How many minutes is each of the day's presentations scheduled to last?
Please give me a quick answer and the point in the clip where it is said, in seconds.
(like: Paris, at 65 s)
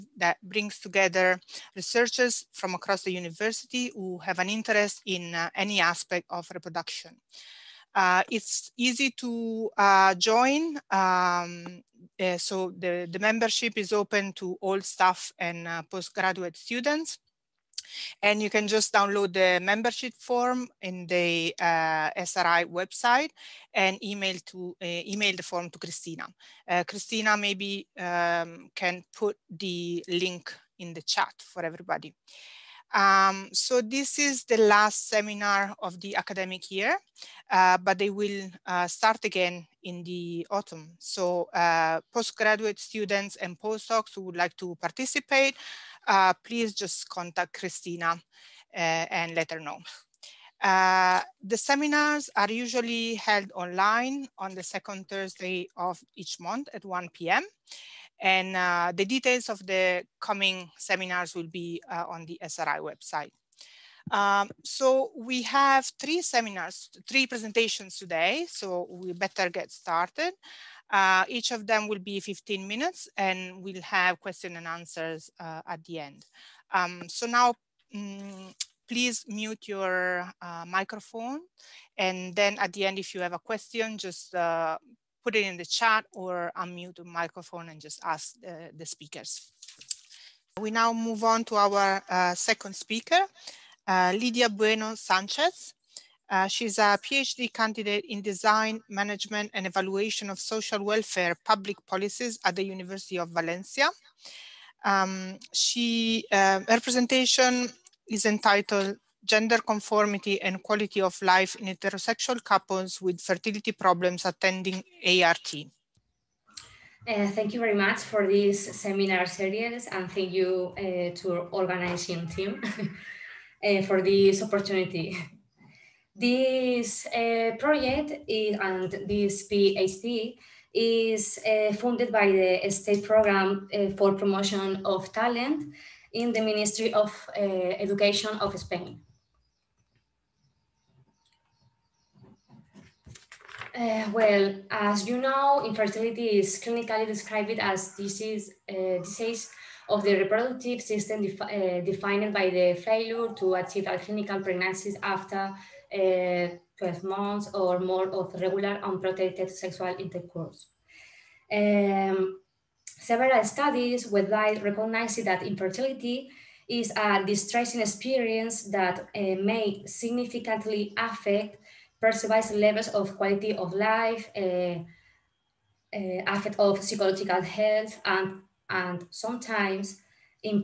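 15, at 72 s.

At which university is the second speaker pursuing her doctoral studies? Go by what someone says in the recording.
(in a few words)
University of Valencia.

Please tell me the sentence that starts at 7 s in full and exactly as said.
Uh, it's easy to uh, join, um, uh, so the, the membership is open to all staff and postgraduate students.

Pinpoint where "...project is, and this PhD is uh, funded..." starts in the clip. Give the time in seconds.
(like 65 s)
127 s.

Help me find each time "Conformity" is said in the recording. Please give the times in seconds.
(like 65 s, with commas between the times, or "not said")
109 s.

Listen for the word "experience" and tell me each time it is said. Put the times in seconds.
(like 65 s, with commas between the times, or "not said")
167 s.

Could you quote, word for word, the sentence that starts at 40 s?
So uh, postgraduate students and postdocs who would like to participate uh, please just contact Christina uh, and let her know.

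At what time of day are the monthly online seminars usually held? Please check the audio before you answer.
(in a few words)
1 p.m.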